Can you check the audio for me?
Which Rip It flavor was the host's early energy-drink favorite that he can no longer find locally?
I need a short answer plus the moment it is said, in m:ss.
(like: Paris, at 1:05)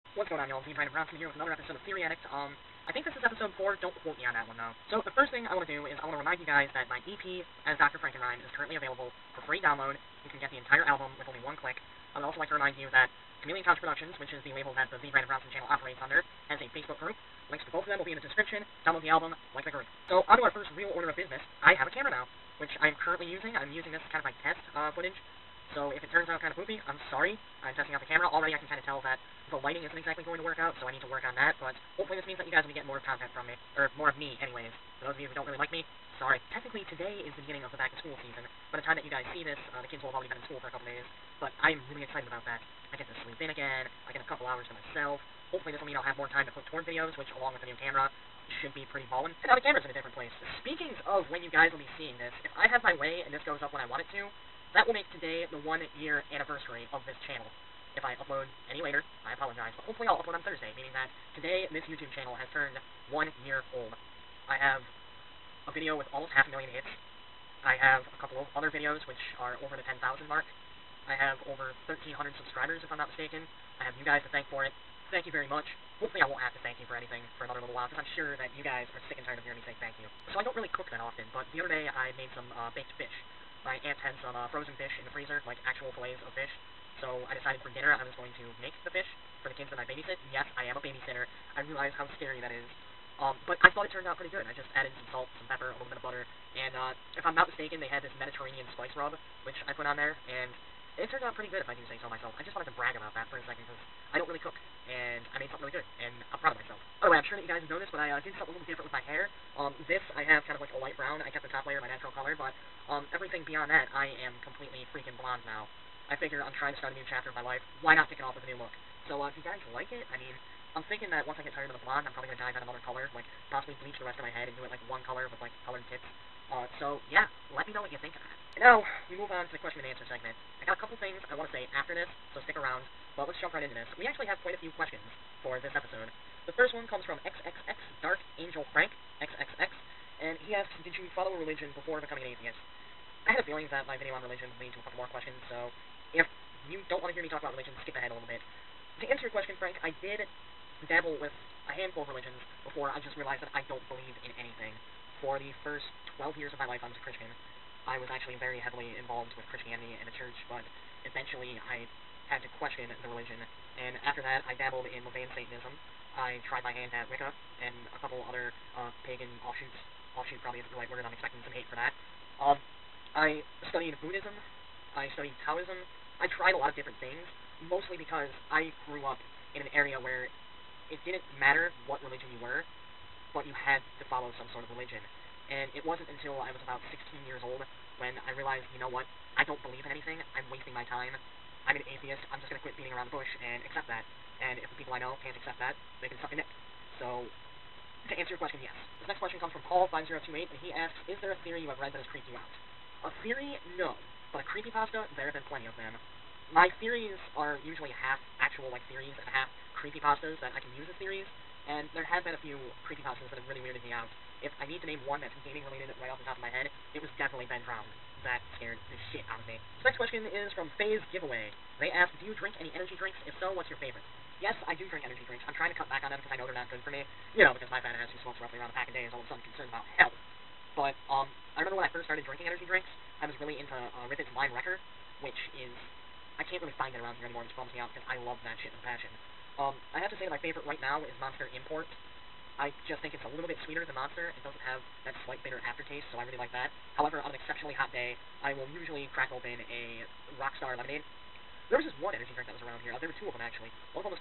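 Lime Wrecker, at 3:54.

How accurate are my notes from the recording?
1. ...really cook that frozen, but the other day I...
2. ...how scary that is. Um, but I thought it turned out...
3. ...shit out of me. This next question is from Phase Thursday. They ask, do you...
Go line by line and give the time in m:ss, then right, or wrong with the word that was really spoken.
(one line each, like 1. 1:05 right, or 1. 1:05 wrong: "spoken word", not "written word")
1. 1:20 wrong: "often", not "frozen"
2. 1:31 right
3. 3:39 wrong: "Giveaway", not "Thursday".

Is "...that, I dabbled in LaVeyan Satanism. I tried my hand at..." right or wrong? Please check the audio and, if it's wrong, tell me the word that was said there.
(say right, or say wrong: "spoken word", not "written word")
right.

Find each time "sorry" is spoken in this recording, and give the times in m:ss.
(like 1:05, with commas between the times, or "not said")
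0:27, 0:36.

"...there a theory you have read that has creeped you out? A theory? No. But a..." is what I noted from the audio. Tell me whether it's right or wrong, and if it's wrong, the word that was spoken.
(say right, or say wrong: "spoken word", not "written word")
right.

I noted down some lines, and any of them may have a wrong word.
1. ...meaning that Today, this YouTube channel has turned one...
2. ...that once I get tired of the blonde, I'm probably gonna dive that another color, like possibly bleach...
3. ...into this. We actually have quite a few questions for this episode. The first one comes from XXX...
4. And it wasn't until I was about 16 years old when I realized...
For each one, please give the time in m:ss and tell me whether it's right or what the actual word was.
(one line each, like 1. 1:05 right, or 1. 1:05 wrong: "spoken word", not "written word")
1. 1:00 right
2. 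2:01 right
3. 2:13 right
4. 3:05 right.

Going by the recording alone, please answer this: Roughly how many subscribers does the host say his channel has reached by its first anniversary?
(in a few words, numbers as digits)
1,300.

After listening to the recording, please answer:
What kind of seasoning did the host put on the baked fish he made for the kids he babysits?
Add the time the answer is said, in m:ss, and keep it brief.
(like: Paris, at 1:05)
Mediterranean spice rub, at 1:38.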